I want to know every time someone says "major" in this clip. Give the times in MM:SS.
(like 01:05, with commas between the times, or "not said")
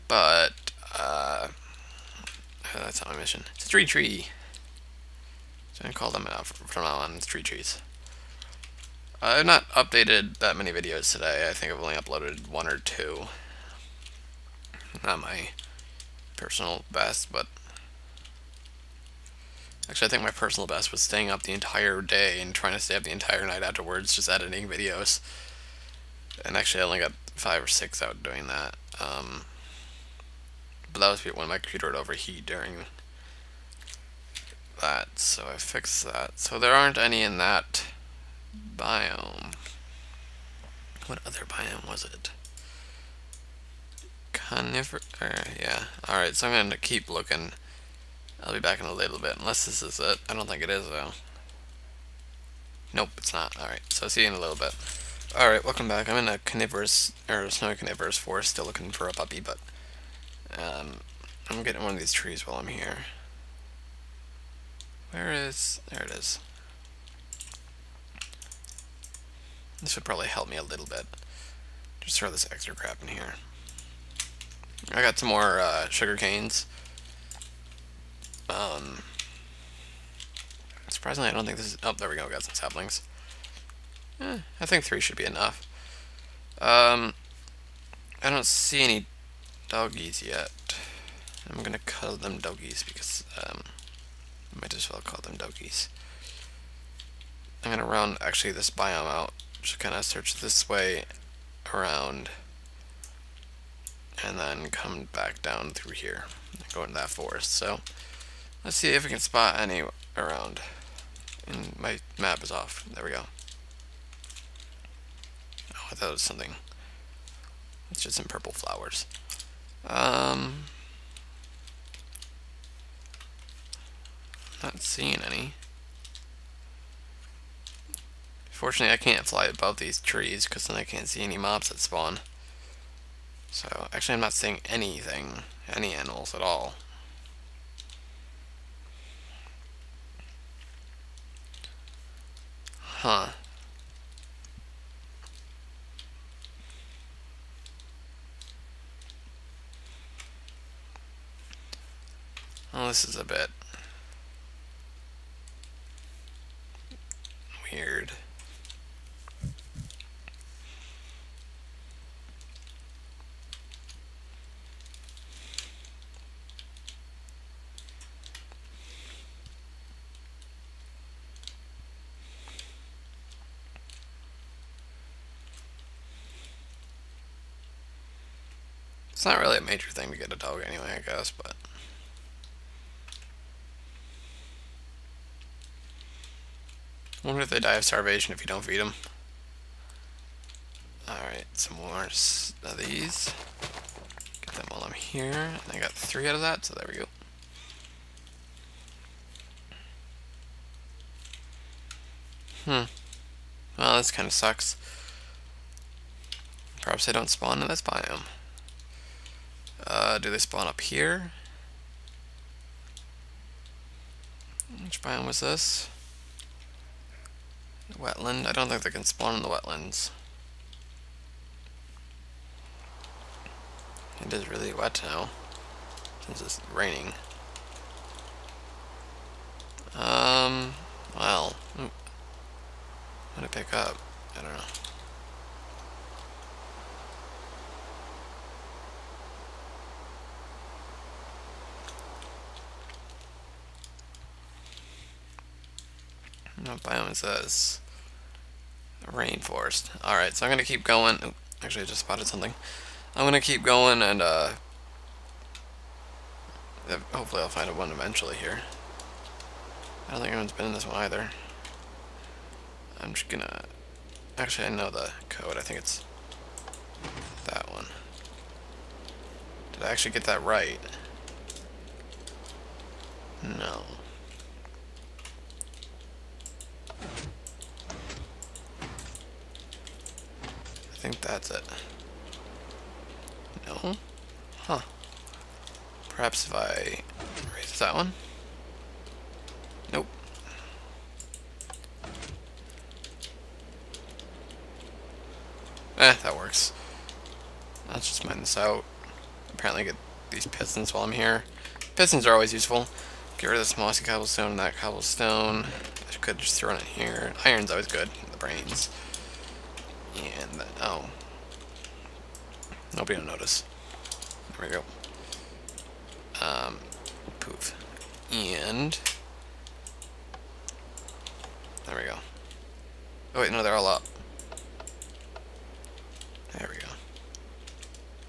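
02:59.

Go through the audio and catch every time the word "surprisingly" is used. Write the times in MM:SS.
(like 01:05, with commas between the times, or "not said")
01:20.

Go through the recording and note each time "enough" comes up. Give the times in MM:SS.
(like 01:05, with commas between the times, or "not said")
01:25.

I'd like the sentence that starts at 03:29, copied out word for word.
Uh, do they spawn up here?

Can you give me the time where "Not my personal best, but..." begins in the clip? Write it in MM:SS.
00:15.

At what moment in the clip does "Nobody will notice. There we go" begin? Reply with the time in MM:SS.
05:12.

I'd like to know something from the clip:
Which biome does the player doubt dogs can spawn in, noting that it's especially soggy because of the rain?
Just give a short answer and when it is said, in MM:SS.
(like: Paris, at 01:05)
wetlands, at 03:39.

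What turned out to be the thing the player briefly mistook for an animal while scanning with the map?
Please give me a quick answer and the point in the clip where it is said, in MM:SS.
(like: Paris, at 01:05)
purple flowers, at 01:58.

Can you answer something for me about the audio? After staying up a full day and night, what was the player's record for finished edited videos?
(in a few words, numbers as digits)
5 or 6.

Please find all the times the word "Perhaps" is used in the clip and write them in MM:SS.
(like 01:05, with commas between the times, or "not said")
03:26, 04:46.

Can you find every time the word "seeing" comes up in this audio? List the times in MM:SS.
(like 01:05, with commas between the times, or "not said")
02:04, 02:14.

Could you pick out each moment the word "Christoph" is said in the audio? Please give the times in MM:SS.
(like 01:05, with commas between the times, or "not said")
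not said.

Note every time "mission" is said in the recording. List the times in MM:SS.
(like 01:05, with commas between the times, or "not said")
00:03.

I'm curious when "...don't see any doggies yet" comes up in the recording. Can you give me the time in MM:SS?
01:28.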